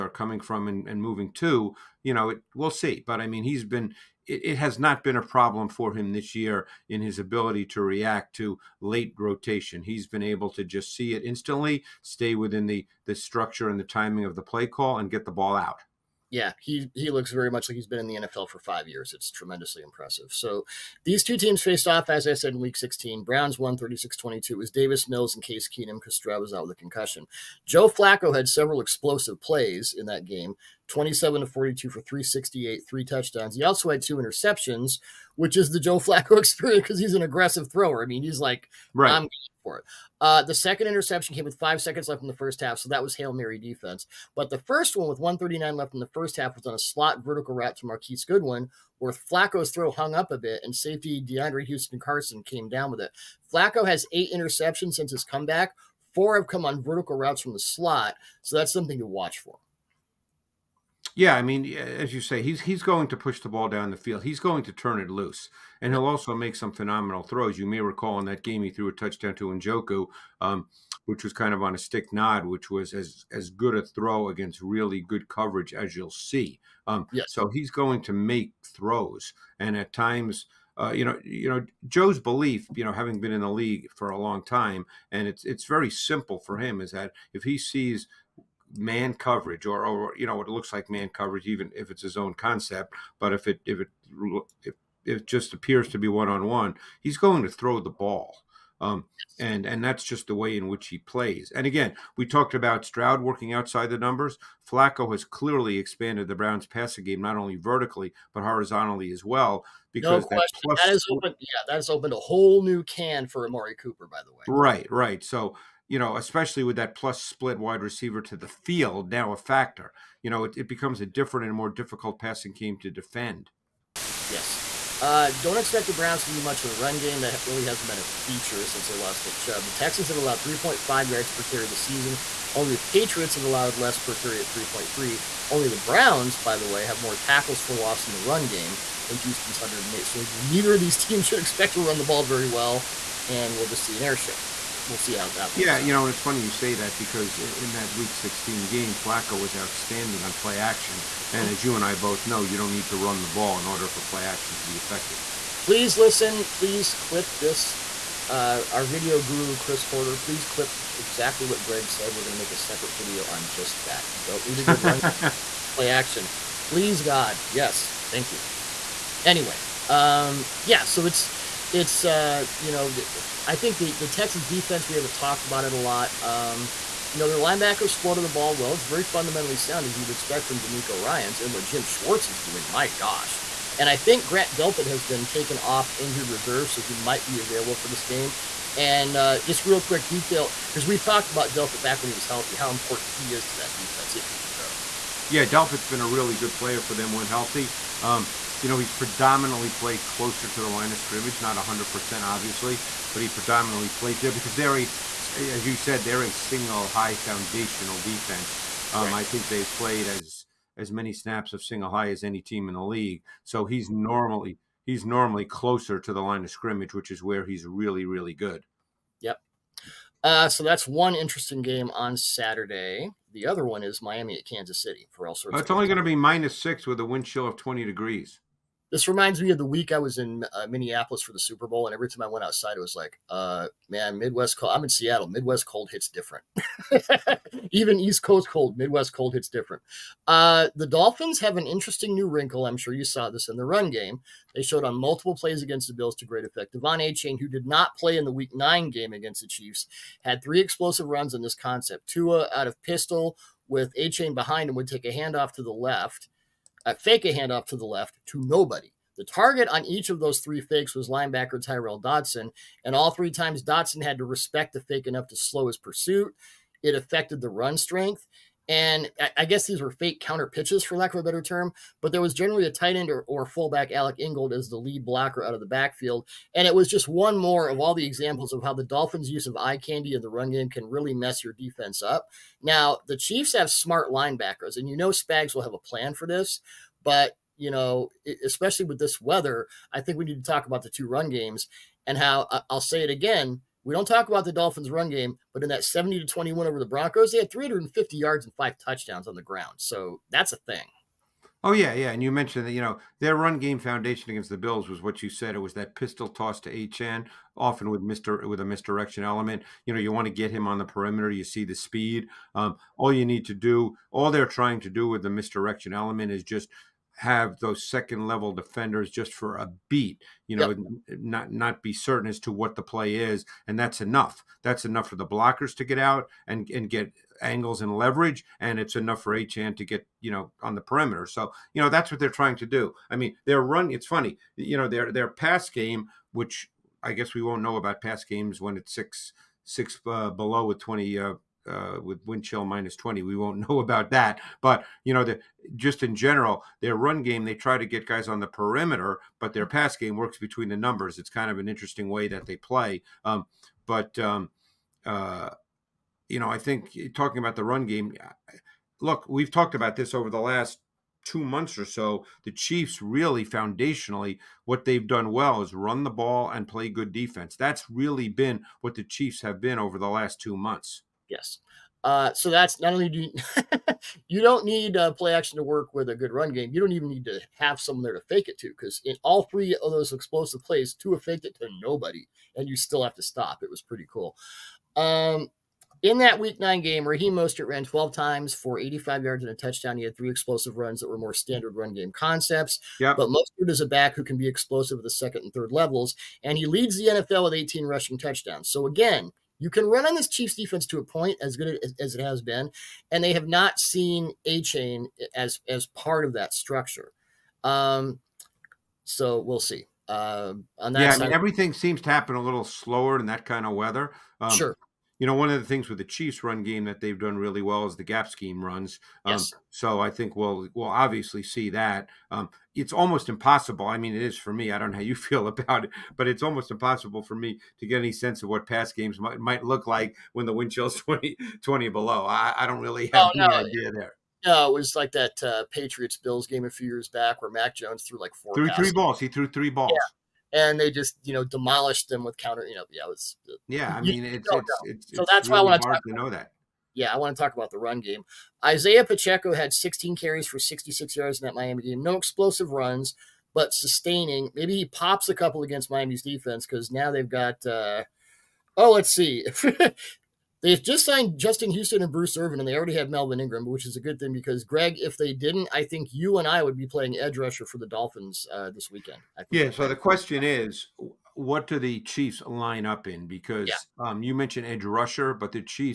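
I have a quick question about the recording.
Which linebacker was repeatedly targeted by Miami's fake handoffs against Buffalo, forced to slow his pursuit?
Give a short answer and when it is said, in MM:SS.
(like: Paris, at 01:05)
Tyrel Dodson, at 04:21.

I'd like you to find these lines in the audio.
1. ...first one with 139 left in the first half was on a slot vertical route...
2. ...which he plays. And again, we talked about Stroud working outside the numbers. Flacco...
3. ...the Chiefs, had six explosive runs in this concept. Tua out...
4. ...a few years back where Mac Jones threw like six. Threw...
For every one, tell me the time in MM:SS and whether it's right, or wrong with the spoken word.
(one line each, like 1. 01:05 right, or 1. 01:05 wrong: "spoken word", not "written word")
1. 00:44 right
2. 01:40 right
3. 04:09 wrong: "three", not "six"
4. 07:16 wrong: "four", not "six".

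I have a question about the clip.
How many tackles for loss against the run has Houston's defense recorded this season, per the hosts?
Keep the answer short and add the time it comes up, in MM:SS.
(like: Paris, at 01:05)
108, at 02:19.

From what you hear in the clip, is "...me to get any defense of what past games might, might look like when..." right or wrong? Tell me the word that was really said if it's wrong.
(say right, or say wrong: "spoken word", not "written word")
wrong: "sense", not "defense".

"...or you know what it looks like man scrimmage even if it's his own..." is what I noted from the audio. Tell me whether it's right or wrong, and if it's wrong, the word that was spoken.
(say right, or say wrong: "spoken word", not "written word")
wrong: "coverage", not "scrimmage".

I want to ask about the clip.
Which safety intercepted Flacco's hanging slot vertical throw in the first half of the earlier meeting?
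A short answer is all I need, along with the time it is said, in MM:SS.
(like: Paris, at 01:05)
DeAndre Houston Carson, at 00:51.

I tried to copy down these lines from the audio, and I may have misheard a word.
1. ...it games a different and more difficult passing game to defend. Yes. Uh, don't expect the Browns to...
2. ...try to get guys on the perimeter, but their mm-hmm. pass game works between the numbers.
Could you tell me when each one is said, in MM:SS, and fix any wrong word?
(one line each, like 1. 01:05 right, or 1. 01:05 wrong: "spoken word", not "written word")
1. 02:00 wrong: "becomes", not "games"
2. 05:47 right.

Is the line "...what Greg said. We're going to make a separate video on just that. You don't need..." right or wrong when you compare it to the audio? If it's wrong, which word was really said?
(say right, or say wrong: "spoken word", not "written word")
right.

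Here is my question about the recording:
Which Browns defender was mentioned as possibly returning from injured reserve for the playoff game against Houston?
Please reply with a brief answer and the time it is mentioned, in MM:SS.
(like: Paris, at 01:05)
Grant Delpit, at 03:04.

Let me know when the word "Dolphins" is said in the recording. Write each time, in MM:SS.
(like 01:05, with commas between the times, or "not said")
04:00, 04:38, 04:54, 07:47.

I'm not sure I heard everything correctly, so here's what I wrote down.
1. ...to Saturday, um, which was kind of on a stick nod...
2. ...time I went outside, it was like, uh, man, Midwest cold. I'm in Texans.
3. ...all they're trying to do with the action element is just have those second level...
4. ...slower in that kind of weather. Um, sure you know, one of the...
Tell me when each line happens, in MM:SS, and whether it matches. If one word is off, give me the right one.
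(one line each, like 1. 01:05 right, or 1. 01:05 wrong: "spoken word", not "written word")
1. 01:09 wrong: "Njoku", not "Saturday"
2. 03:52 wrong: "Seattle", not "Texans"
3. 05:14 wrong: "misdirection", not "action"
4. 06:52 right.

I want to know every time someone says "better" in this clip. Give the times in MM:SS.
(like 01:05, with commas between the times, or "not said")
04:31.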